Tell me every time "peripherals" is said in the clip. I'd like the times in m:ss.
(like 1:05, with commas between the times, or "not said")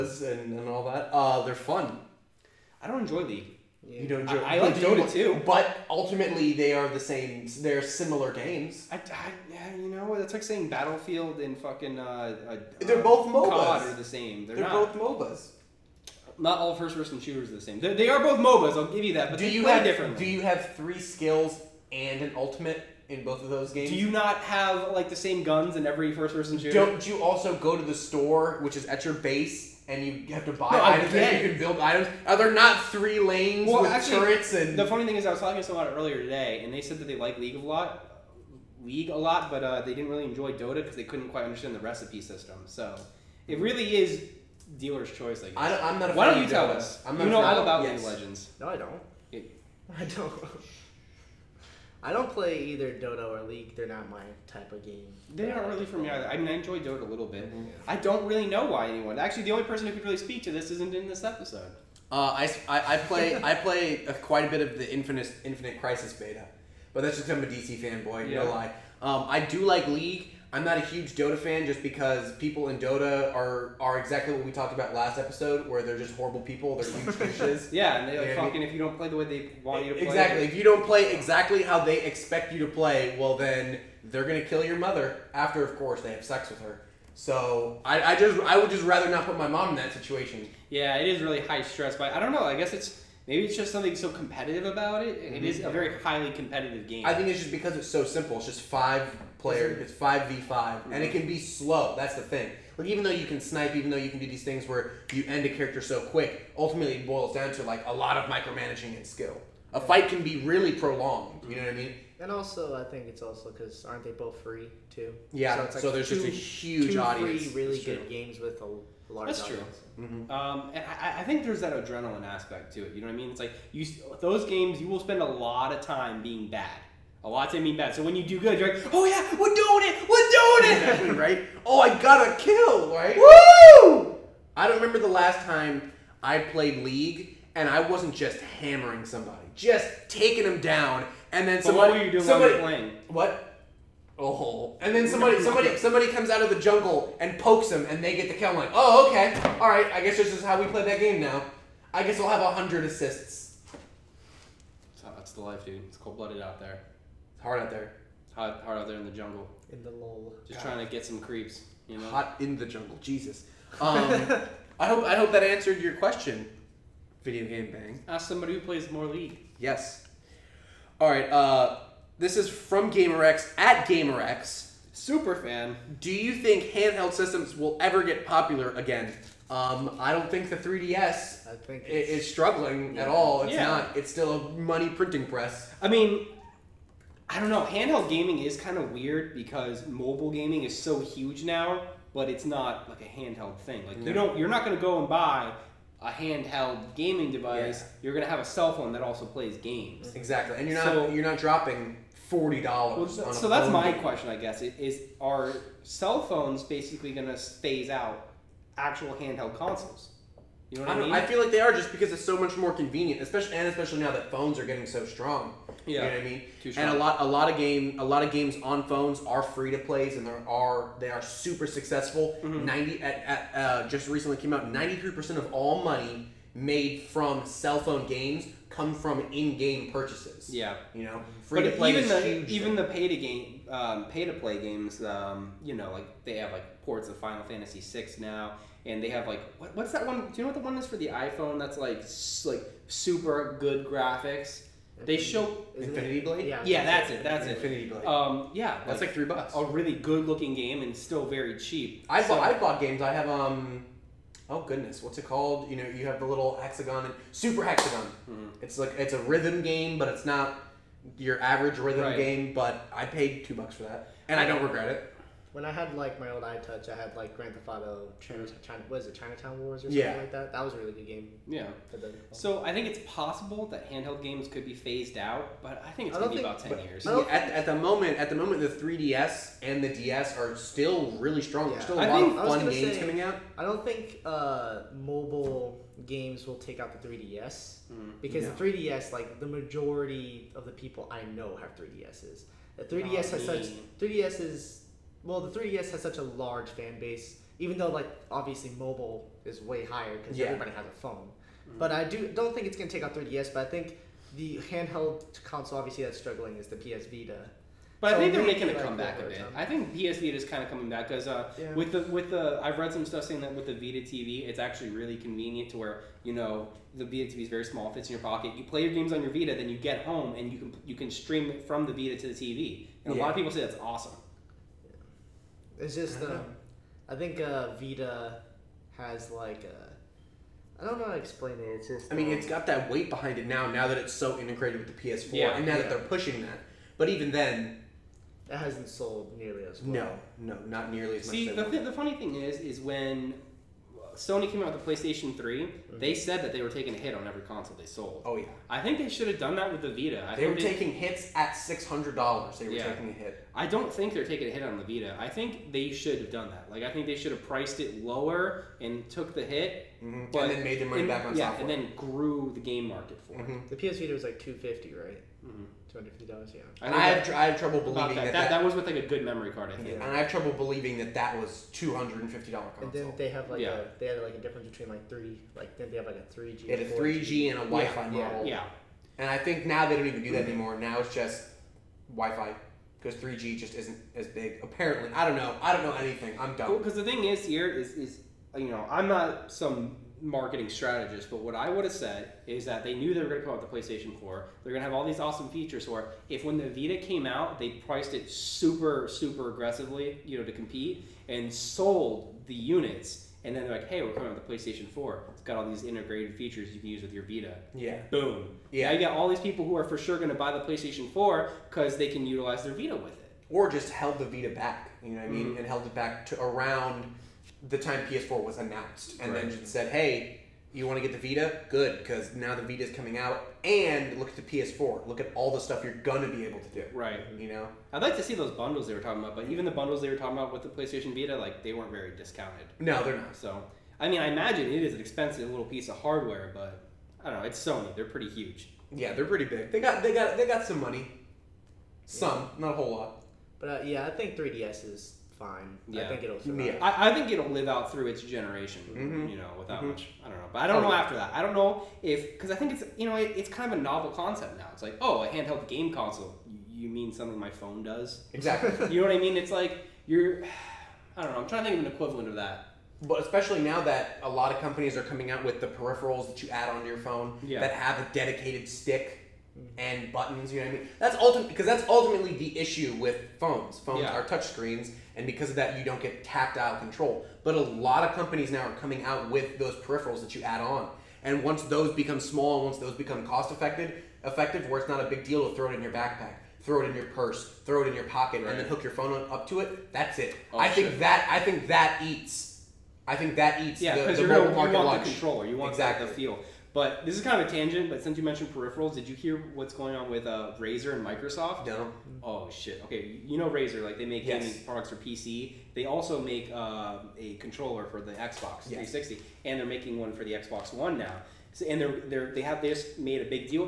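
7:45, 7:59, 8:18.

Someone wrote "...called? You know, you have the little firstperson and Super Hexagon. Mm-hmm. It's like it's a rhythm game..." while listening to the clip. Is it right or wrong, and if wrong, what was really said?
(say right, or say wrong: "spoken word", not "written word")
wrong: "hexagon", not "firstperson".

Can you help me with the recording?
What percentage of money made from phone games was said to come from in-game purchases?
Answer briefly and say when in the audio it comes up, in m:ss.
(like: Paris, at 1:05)
93%, at 3:44.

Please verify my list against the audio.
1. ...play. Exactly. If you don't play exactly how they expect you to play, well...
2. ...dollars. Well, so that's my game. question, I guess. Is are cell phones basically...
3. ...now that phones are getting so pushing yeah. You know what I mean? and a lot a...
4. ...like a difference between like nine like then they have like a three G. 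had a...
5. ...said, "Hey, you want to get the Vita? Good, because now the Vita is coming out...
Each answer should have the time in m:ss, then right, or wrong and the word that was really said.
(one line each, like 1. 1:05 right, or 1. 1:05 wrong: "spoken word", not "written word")
1. 1:19 right
2. 3:22 right
3. 3:33 wrong: "strong", not "pushing"
4. 6:14 wrong: "three", not "nine"
5. 6:59 right.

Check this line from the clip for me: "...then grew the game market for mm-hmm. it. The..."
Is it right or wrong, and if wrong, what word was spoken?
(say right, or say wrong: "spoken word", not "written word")
right.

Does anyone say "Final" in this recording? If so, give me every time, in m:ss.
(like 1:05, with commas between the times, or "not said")
3:57.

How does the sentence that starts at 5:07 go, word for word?
But so I think they're making a like comeback a bit.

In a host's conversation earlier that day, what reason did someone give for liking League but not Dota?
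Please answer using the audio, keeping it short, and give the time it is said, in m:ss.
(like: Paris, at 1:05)
the recipe system, at 0:41.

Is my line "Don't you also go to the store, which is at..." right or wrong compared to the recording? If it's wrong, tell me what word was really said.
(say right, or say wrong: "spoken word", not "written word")
right.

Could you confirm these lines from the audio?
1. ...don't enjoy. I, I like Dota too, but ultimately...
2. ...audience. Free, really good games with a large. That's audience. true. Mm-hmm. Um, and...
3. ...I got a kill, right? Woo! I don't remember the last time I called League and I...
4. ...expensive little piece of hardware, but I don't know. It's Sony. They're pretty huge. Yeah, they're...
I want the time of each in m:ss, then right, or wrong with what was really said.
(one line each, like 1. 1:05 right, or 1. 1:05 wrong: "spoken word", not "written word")
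1. 0:04 right
2. 1:56 right
3. 2:11 wrong: "played", not "called"
4. 7:14 right.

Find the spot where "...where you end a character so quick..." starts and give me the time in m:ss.
1:44.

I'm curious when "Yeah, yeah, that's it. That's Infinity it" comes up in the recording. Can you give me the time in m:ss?
4:06.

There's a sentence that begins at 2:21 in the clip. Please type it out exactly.
But what you doing somebody, while playing?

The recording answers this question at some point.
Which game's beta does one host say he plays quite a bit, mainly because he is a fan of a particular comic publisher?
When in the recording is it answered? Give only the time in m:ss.
1:05.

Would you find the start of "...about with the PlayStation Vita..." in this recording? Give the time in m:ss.
7:10.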